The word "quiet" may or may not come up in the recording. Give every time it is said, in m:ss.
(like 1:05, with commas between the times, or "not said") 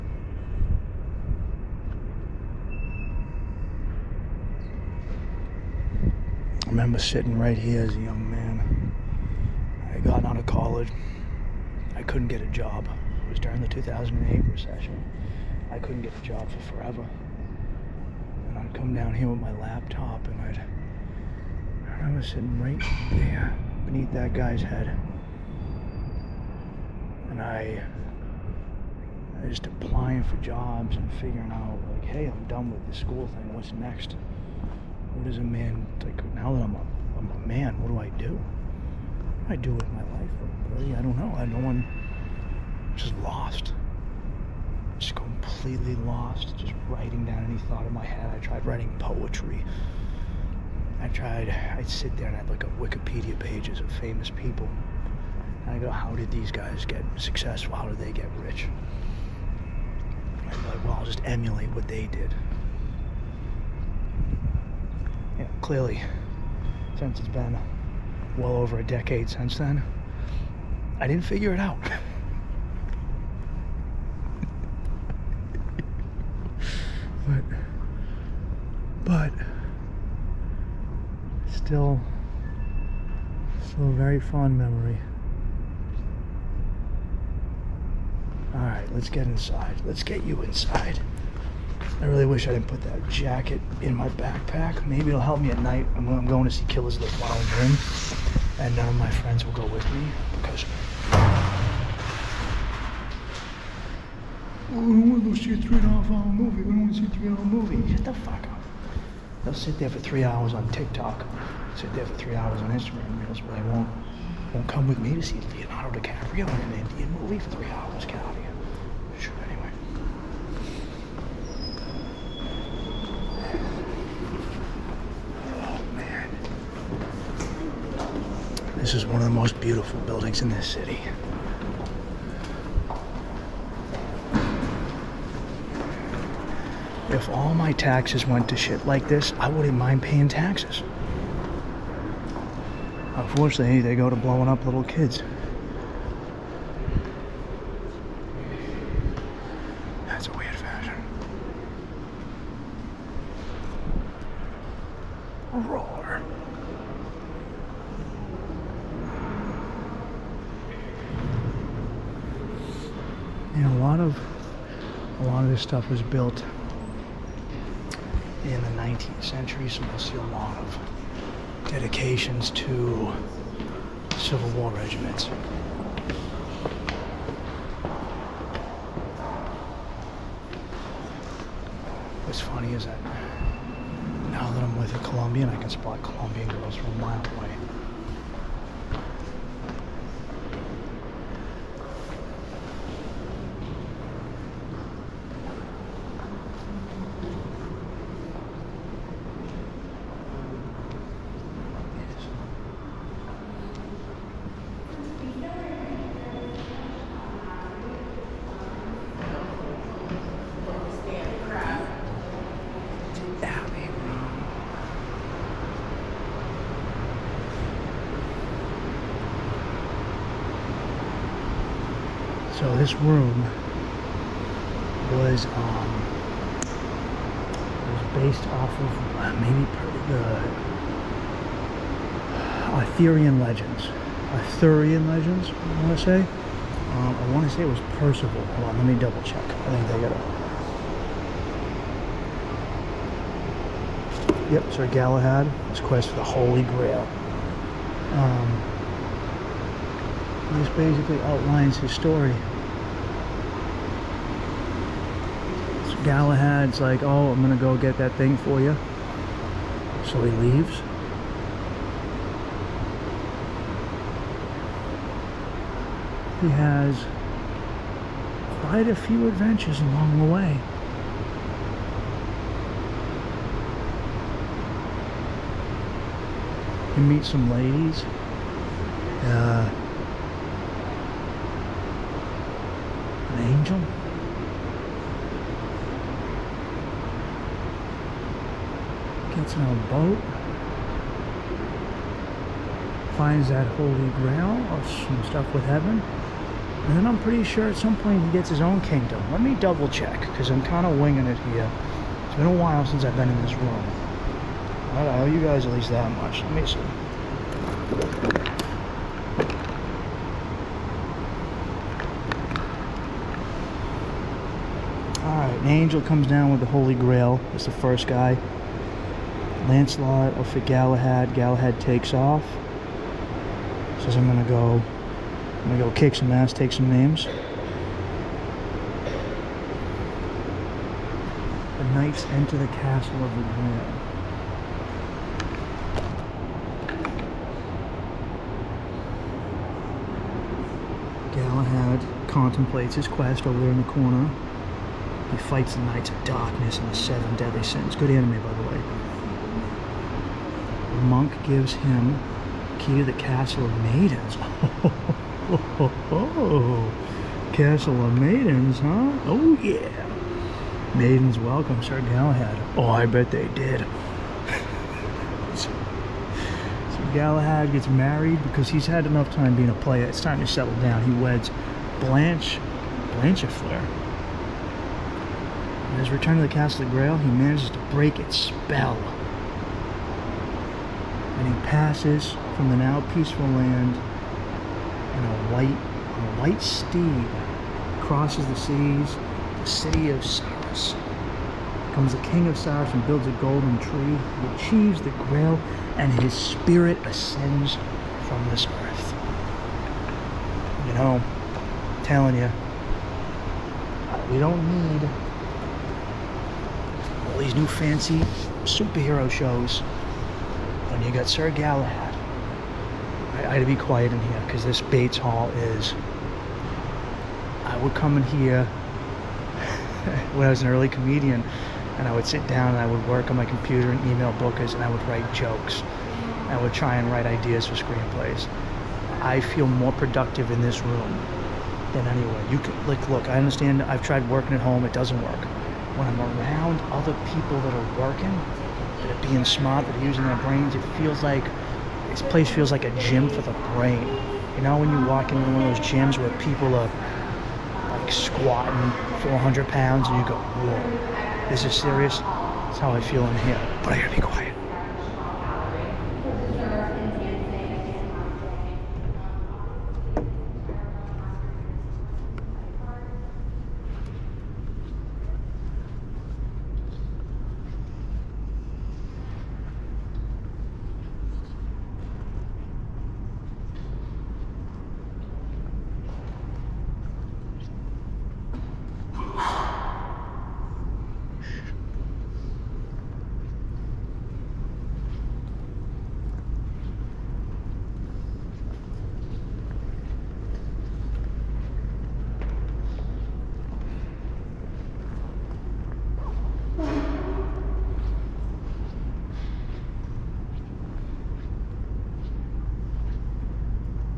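6:53, 7:34.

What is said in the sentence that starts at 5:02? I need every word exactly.
It's been a while since I've been in this room.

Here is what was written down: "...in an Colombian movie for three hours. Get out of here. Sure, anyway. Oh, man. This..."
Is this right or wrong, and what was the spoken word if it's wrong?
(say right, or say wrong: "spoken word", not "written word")
wrong: "Indian", not "Colombian".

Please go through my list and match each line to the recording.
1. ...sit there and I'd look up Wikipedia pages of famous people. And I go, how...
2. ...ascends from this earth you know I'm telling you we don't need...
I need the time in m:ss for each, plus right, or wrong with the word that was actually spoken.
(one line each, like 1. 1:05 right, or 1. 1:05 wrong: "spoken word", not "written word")
1. 0:51 right
2. 6:37 right.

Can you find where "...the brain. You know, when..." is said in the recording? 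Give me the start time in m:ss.
7:23.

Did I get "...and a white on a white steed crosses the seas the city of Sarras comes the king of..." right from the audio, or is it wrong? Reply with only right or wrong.
right.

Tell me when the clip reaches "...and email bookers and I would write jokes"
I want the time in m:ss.
7:03.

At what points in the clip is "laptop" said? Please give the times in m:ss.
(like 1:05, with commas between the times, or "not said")
0:19.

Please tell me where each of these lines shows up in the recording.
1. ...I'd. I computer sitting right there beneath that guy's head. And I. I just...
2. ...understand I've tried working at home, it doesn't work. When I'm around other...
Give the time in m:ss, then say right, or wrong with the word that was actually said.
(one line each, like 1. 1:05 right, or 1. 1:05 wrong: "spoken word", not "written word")
1. 0:20 wrong: "remember", not "computer"
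2. 7:13 right.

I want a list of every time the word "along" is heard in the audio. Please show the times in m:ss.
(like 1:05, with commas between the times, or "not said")
4:29.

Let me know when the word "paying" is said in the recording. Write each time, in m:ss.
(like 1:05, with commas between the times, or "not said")
2:20.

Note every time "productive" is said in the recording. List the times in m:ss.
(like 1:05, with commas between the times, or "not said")
7:09.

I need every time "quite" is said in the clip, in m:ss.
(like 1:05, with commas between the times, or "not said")
4:28.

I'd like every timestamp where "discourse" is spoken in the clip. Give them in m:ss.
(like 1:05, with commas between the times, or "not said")
not said.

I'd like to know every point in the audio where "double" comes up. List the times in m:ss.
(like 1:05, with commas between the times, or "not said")
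3:59, 4:59.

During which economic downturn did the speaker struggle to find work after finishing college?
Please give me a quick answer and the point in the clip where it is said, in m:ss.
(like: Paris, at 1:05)
2008 recession, at 0:13.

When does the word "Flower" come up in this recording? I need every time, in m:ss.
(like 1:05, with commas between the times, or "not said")
1:37.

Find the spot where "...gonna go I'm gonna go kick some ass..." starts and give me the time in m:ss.
5:24.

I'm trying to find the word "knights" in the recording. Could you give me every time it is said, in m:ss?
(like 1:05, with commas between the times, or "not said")
5:31, 5:45.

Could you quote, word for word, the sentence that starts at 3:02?
What's funny is that now that I'm with a Colombian, I can spot Colombian girls from a mile away.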